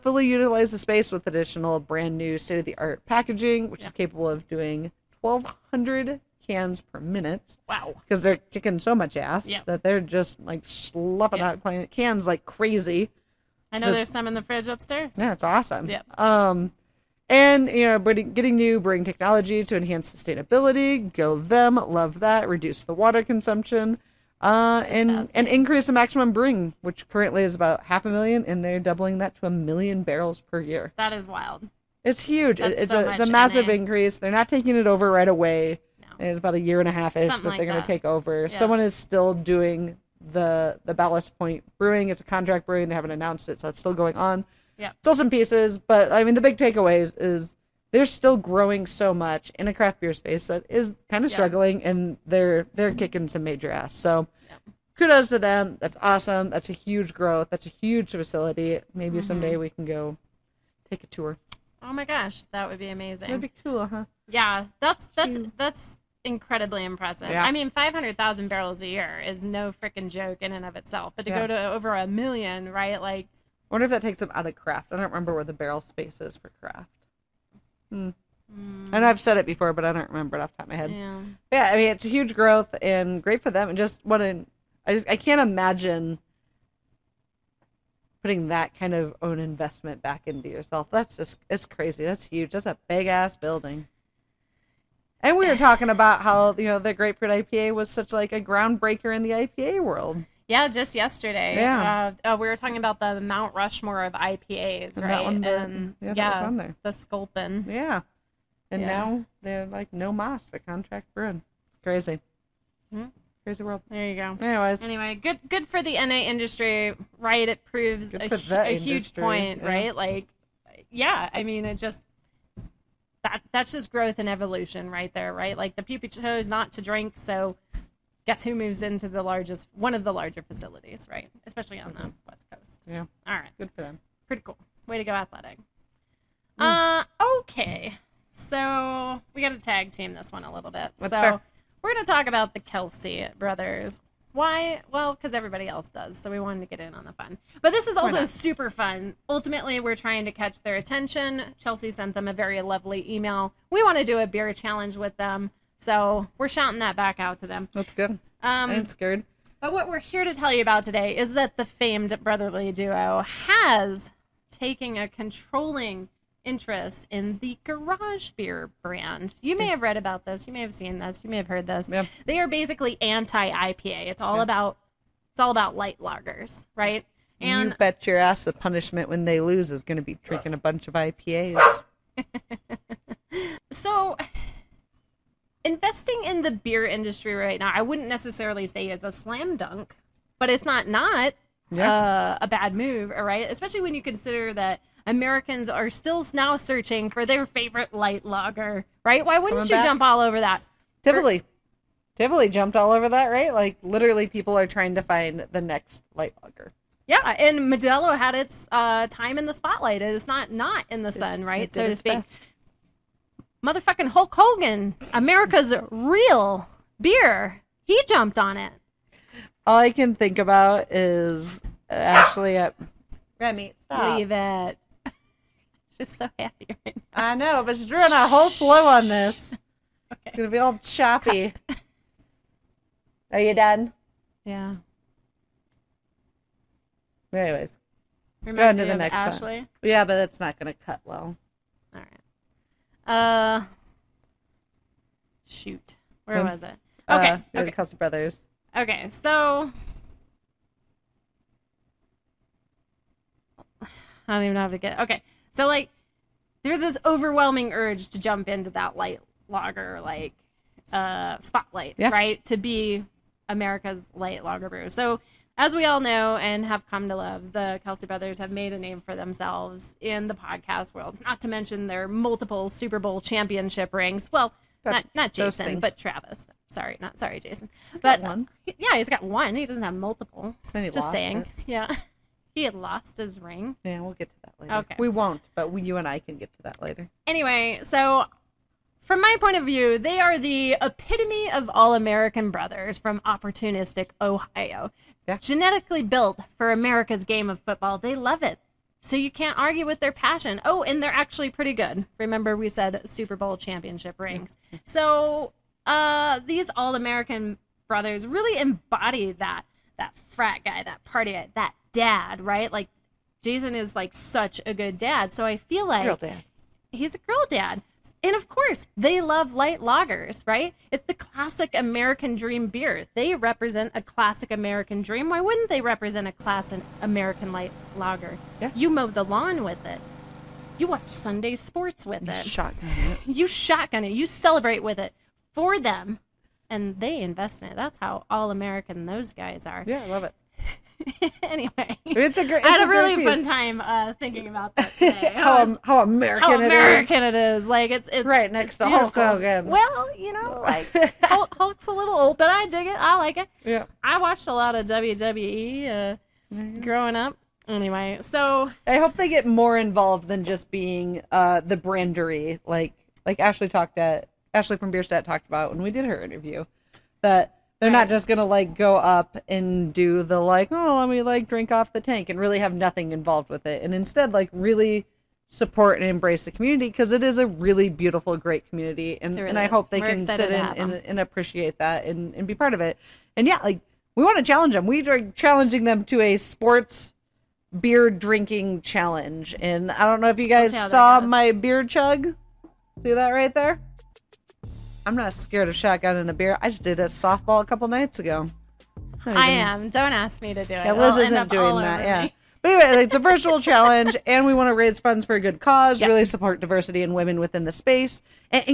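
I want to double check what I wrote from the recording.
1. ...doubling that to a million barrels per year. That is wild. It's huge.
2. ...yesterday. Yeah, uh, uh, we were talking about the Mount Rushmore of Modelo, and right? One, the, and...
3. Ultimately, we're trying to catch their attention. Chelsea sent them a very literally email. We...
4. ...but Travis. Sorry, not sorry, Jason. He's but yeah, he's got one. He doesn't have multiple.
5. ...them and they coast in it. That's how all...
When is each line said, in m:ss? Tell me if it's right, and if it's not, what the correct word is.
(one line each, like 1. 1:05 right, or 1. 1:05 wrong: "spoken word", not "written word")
1. 0:28 right
2. 1:40 wrong: "IPAs", not "Modelo"
3. 2:29 wrong: "lovely", not "literally"
4. 4:35 right
5. 5:35 wrong: "invest", not "coast".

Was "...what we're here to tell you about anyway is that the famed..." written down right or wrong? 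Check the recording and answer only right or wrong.
wrong.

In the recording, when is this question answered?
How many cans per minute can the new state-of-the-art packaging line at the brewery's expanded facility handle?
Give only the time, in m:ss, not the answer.
0:05.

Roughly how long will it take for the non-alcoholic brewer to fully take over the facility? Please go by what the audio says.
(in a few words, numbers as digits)
a year and a half.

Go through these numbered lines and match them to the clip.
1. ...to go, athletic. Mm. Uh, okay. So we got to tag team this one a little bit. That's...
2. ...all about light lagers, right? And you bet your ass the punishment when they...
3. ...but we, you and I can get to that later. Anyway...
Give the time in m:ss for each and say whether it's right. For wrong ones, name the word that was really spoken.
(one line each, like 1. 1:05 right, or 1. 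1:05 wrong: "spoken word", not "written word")
1. 2:14 right
2. 2:55 right
3. 4:45 right.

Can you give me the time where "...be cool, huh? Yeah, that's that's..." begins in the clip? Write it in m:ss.
1:03.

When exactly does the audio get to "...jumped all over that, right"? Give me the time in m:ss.
3:22.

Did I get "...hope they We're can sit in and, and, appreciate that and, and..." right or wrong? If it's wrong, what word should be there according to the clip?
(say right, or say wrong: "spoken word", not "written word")
right.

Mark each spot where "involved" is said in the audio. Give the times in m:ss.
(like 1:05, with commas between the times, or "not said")
5:59, 6:13.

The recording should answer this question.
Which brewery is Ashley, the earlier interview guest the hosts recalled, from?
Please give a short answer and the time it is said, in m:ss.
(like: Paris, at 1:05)
Bierstadt, at 6:04.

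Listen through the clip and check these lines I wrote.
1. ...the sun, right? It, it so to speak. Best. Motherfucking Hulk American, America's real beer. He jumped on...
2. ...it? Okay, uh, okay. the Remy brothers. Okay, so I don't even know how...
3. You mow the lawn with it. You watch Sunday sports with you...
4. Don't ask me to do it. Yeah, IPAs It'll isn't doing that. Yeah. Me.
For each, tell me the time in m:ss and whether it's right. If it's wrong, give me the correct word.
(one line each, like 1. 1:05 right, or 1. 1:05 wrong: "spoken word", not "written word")
1. 3:31 wrong: "Hogan", not "American"
2. 4:06 wrong: "Kelce", not "Remy"
3. 5:28 right
4. 6:39 wrong: "Liz", not "IPAs".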